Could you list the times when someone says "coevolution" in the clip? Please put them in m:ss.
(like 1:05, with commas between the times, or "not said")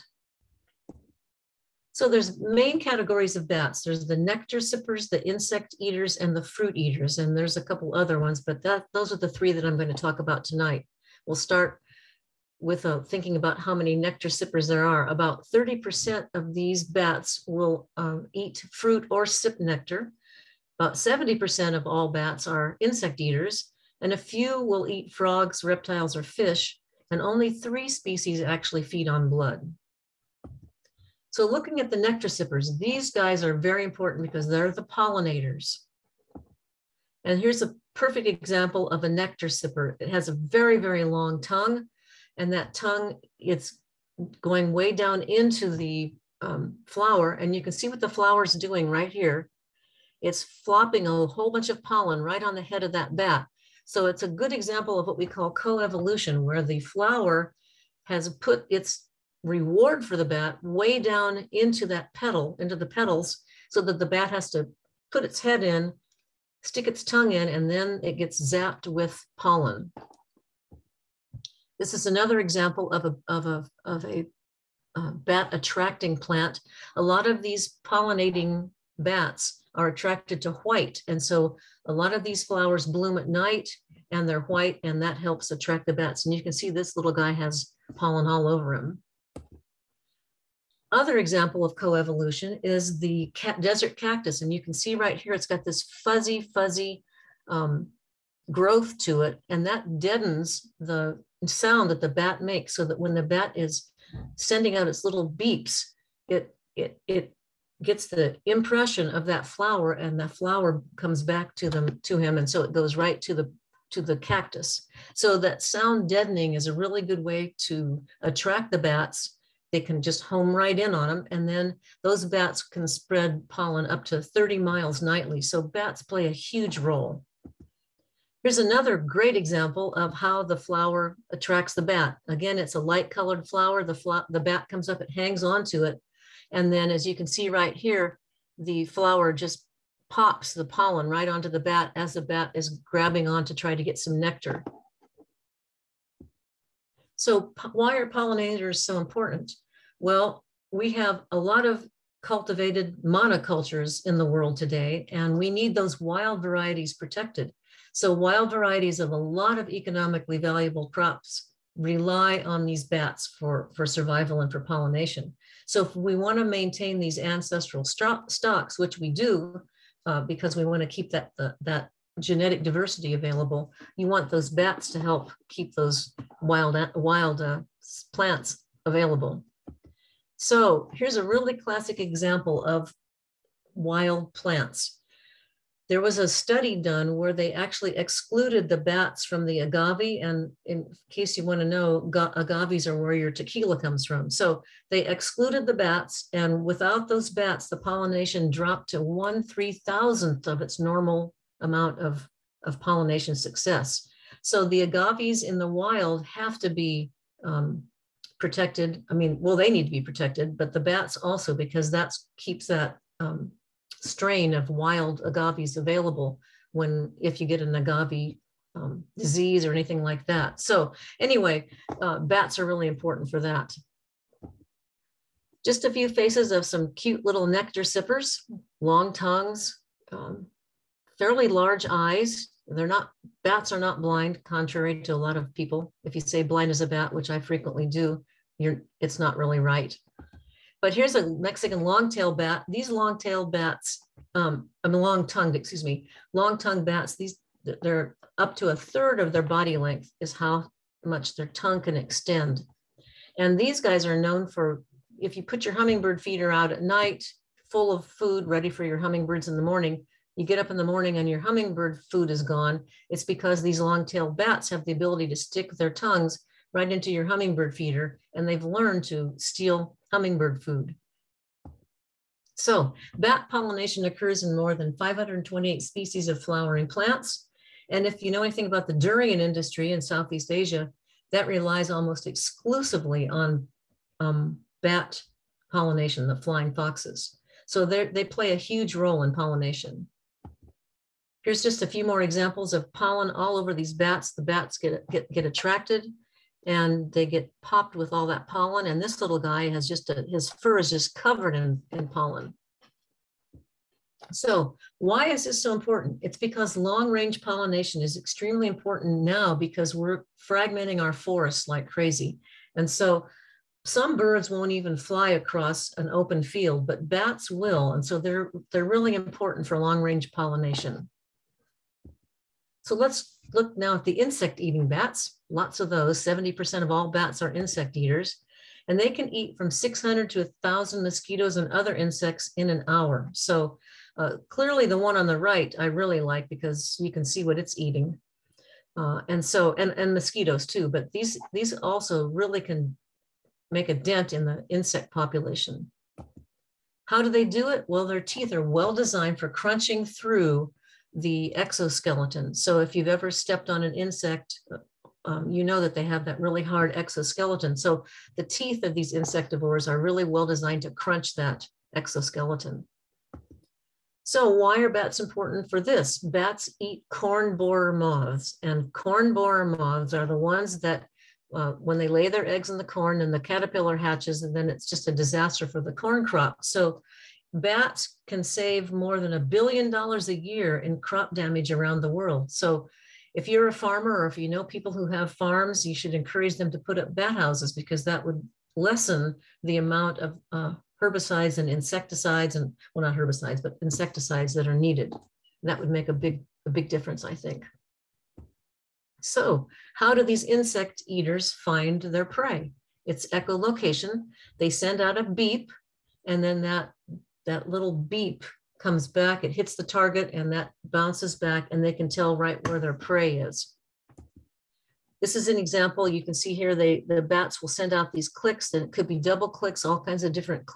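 0:55, 1:31.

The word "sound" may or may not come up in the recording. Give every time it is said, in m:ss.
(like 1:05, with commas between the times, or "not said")
1:41, 1:55.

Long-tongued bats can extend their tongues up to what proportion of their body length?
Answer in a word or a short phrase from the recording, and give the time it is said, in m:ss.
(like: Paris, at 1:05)
a third, at 4:08.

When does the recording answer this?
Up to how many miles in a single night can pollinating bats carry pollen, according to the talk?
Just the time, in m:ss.
2:04.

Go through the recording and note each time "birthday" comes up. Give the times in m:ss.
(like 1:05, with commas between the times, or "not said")
not said.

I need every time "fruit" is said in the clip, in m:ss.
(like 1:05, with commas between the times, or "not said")
0:06, 0:18.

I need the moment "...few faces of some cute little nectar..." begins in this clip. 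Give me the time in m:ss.
3:45.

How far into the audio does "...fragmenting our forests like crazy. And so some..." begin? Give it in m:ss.
5:10.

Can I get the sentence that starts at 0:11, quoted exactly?
We'll start with uh, thinking about how many nectar sippers there are.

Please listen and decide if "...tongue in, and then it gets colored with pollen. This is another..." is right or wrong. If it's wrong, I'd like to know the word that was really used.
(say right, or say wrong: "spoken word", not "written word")
wrong: "zapped", not "colored".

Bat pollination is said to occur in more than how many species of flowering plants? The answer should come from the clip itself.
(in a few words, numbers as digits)
528.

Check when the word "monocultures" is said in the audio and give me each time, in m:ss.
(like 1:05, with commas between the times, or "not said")
2:33.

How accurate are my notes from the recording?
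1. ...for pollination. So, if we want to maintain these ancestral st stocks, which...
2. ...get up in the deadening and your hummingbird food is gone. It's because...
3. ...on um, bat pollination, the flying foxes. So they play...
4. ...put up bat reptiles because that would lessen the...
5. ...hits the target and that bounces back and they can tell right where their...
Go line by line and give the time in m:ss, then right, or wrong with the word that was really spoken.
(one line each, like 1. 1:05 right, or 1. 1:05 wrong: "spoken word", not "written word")
1. 2:44 right
2. 4:20 wrong: "morning", not "deadening"
3. 4:43 right
4. 6:26 wrong: "houses", not "reptiles"
5. 6:49 right.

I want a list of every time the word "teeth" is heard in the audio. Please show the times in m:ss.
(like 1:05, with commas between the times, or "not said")
5:48, 5:58.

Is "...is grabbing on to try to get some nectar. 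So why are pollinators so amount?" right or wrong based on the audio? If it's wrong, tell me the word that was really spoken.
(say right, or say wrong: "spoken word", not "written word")
wrong: "important", not "amount".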